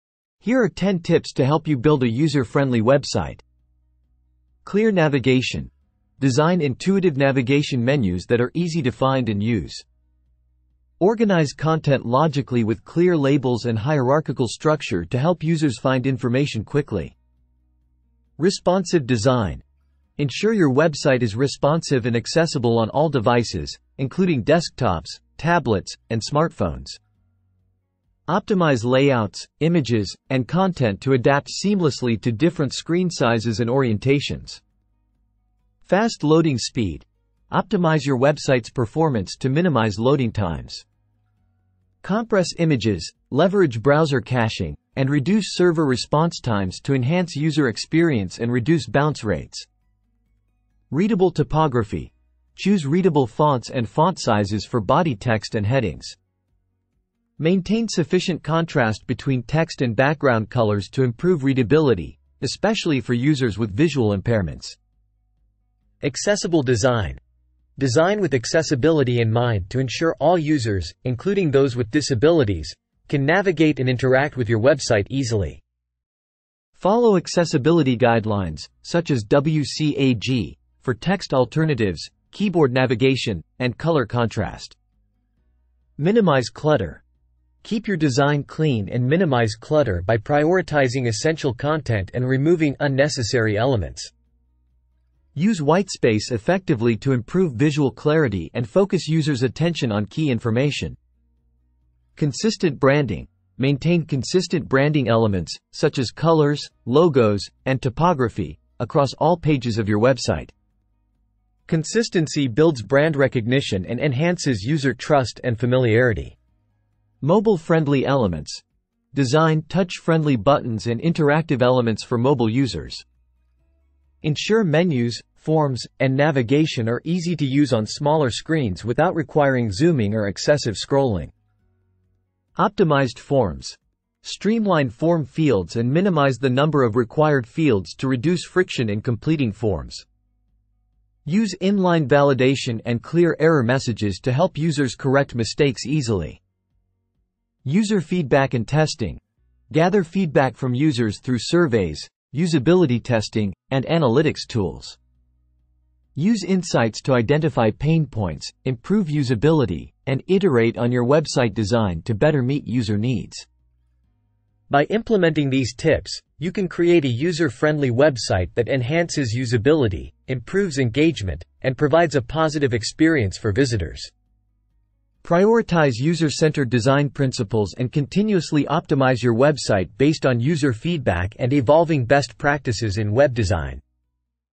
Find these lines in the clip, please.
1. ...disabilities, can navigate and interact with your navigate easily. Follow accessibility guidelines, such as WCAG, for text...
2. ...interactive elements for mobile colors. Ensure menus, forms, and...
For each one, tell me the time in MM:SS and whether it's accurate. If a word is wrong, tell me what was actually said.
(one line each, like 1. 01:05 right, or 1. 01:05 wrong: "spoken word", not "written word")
1. 01:11 wrong: "website", not "navigate"
2. 02:00 wrong: "users", not "colors".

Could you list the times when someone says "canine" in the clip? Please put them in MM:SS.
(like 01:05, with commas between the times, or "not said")
not said.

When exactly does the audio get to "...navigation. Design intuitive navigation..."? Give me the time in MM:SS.
00:04.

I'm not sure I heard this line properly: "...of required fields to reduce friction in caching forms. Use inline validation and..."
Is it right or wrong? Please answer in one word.
wrong.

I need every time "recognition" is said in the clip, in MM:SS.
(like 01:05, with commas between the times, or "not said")
01:53.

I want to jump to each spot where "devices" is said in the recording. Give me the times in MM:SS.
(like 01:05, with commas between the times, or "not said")
00:23.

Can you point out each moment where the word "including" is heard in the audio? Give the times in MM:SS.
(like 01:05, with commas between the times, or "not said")
00:23, 01:11.